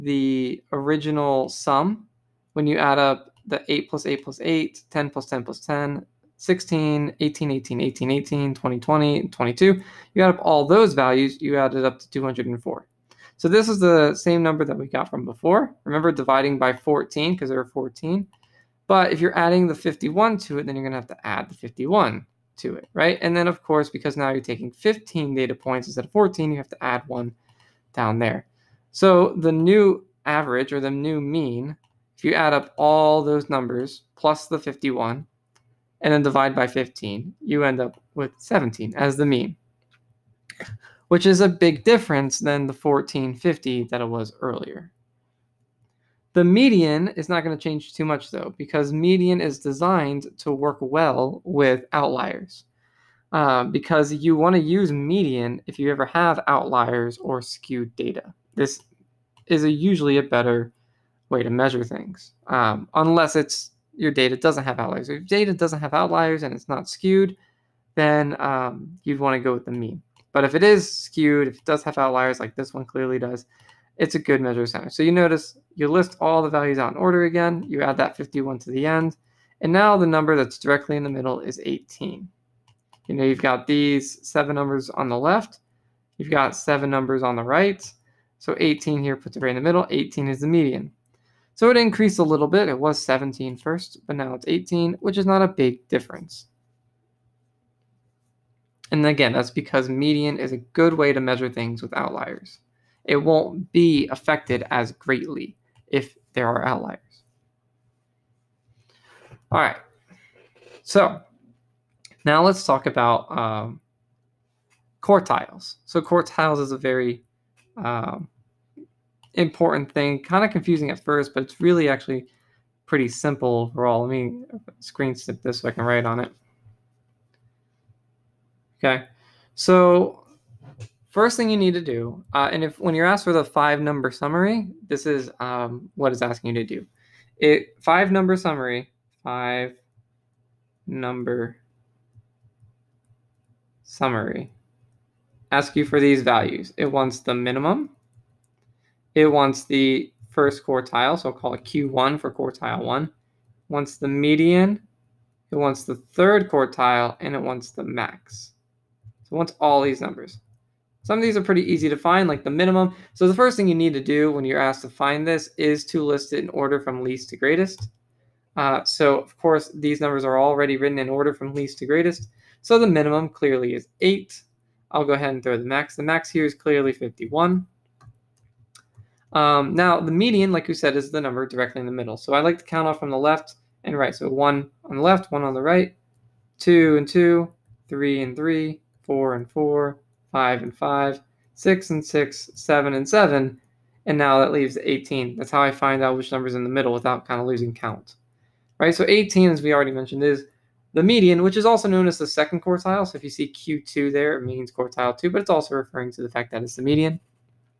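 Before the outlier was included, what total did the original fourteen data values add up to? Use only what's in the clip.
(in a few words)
204.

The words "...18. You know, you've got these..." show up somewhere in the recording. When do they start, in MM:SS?
01:21.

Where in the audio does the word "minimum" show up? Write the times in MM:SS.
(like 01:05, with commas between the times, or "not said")
02:27, 02:42, 02:52.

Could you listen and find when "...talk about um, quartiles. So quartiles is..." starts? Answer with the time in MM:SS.
01:52.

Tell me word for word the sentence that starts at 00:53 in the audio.
Uh, because you want to use median if you ever have outliers or skewed data.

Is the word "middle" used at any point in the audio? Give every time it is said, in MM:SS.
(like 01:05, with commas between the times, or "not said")
01:21, 01:29, 03:01, 03:16.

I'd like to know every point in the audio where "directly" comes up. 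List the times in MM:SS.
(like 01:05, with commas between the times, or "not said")
01:20, 03:01.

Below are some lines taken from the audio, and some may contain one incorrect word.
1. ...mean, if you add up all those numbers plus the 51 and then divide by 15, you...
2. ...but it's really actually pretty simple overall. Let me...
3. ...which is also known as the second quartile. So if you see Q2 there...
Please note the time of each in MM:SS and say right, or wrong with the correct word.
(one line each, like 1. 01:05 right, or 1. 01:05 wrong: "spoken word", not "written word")
1. 00:31 right
2. 02:01 right
3. 03:21 right.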